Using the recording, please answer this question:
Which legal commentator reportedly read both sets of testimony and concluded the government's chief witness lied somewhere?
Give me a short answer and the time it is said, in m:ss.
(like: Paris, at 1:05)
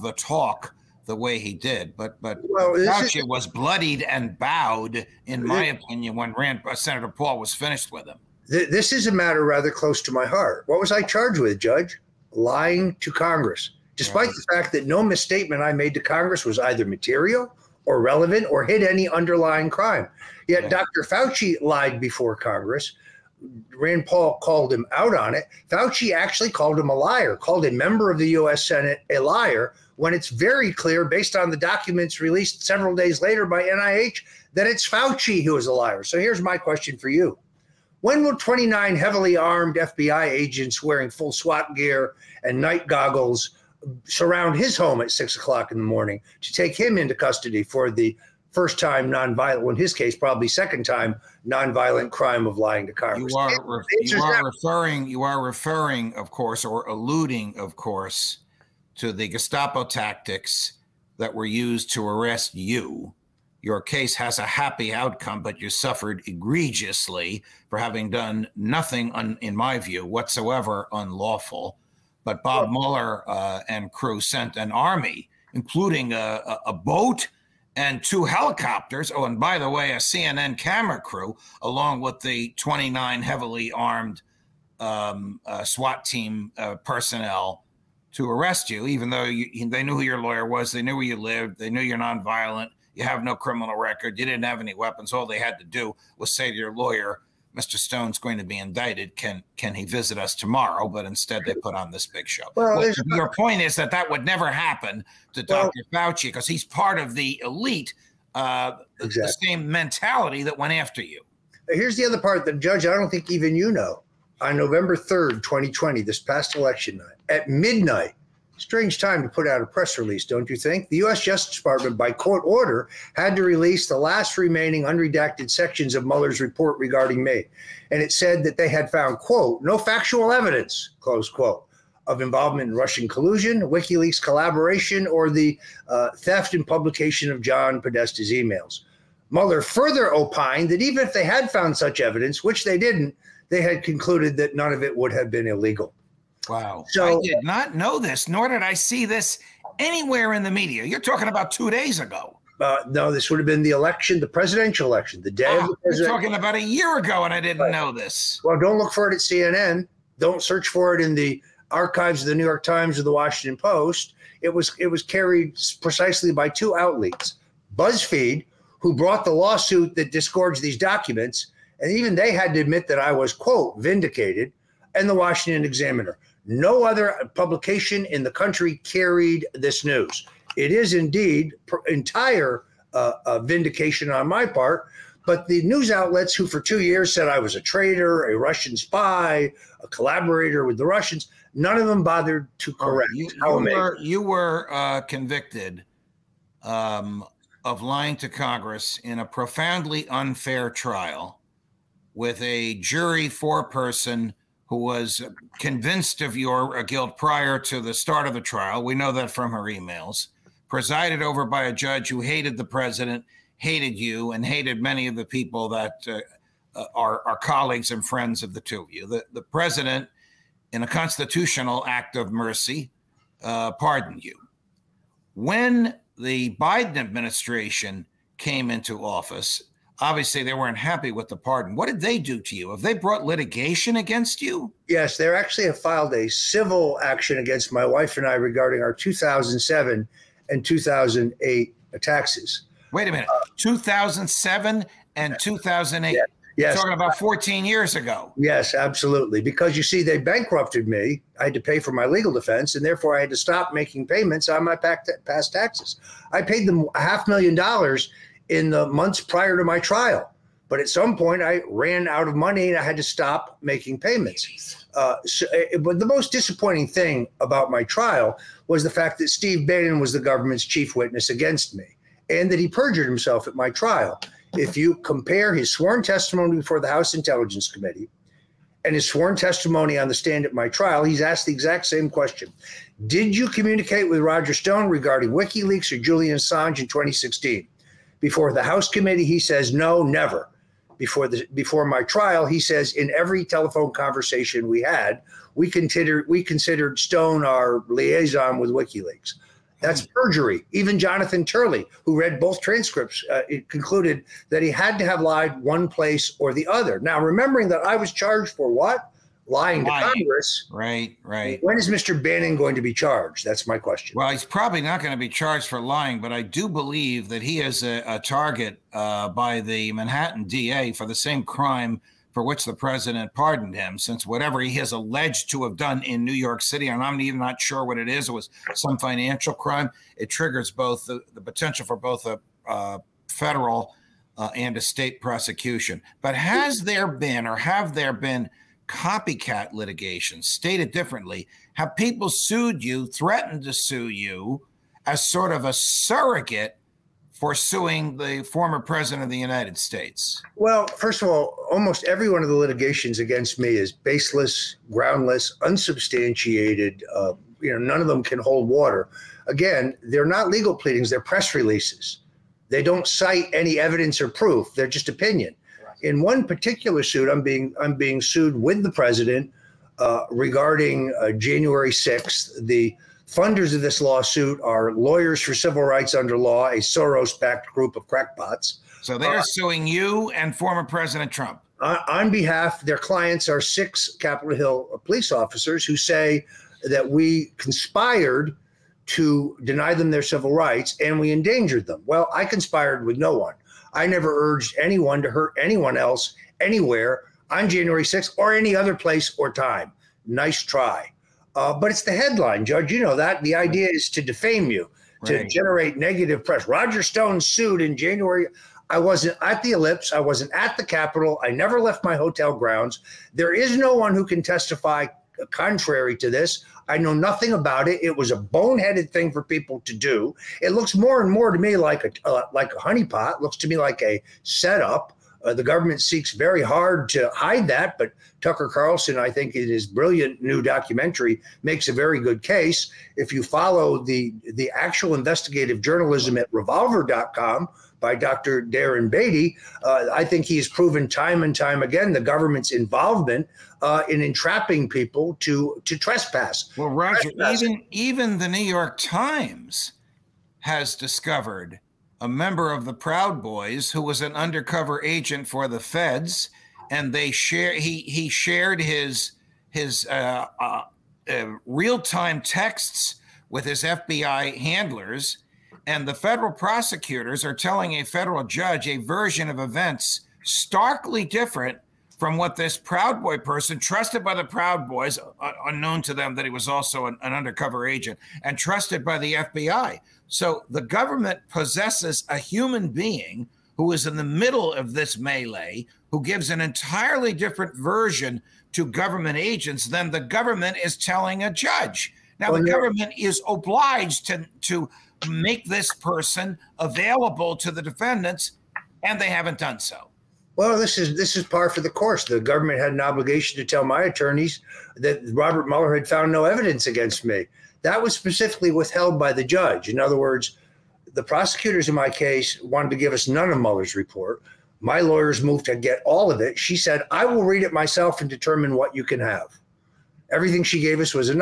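Jonathan Turley, at 5:00.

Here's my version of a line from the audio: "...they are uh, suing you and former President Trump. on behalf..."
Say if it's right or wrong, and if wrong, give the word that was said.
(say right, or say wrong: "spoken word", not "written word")
right.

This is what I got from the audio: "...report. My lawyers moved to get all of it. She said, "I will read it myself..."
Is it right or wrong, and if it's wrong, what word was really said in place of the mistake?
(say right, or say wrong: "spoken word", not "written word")
right.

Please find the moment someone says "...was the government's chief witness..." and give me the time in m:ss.
4:29.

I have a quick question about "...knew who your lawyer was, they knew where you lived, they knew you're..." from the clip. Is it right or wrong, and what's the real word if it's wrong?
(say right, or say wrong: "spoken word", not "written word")
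right.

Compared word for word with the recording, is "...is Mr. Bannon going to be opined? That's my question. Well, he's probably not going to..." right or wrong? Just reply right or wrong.
wrong.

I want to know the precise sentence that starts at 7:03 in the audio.
It looks to me like a setup.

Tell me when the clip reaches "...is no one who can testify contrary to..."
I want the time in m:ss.
6:53.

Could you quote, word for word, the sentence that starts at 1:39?
Can can he visit us tomorrow?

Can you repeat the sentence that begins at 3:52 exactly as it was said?
Have they brought litigation against you?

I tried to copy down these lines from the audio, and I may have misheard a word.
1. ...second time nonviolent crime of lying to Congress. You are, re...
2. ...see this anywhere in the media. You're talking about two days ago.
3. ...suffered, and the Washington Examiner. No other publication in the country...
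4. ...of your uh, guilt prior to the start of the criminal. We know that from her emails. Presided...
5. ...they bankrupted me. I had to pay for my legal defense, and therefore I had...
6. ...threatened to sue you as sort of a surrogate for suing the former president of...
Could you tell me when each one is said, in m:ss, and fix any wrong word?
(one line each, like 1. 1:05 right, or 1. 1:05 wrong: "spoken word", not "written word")
1. 0:50 right
2. 2:28 right
3. 2:53 wrong: "vindicated", not "suffered"
4. 3:26 wrong: "trial", not "criminal"
5. 4:10 right
6. 5:43 right.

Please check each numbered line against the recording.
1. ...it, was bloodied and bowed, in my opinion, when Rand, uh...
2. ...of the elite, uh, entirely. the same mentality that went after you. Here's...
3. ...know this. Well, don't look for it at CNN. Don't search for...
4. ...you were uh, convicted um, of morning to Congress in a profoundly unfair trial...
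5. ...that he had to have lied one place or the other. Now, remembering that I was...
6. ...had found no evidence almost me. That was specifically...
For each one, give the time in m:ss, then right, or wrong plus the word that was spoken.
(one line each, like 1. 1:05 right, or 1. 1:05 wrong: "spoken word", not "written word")
1. 0:03 right
2. 1:46 wrong: "exactly", not "entirely"
3. 2:37 right
4. 3:14 wrong: "lying", not "morning"
5. 5:04 right
6. 8:25 wrong: "against", not "almost".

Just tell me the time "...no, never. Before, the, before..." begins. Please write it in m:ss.
4:49.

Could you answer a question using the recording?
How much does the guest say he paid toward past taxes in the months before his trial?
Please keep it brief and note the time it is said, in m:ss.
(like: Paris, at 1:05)
half million dollars, at 4:16.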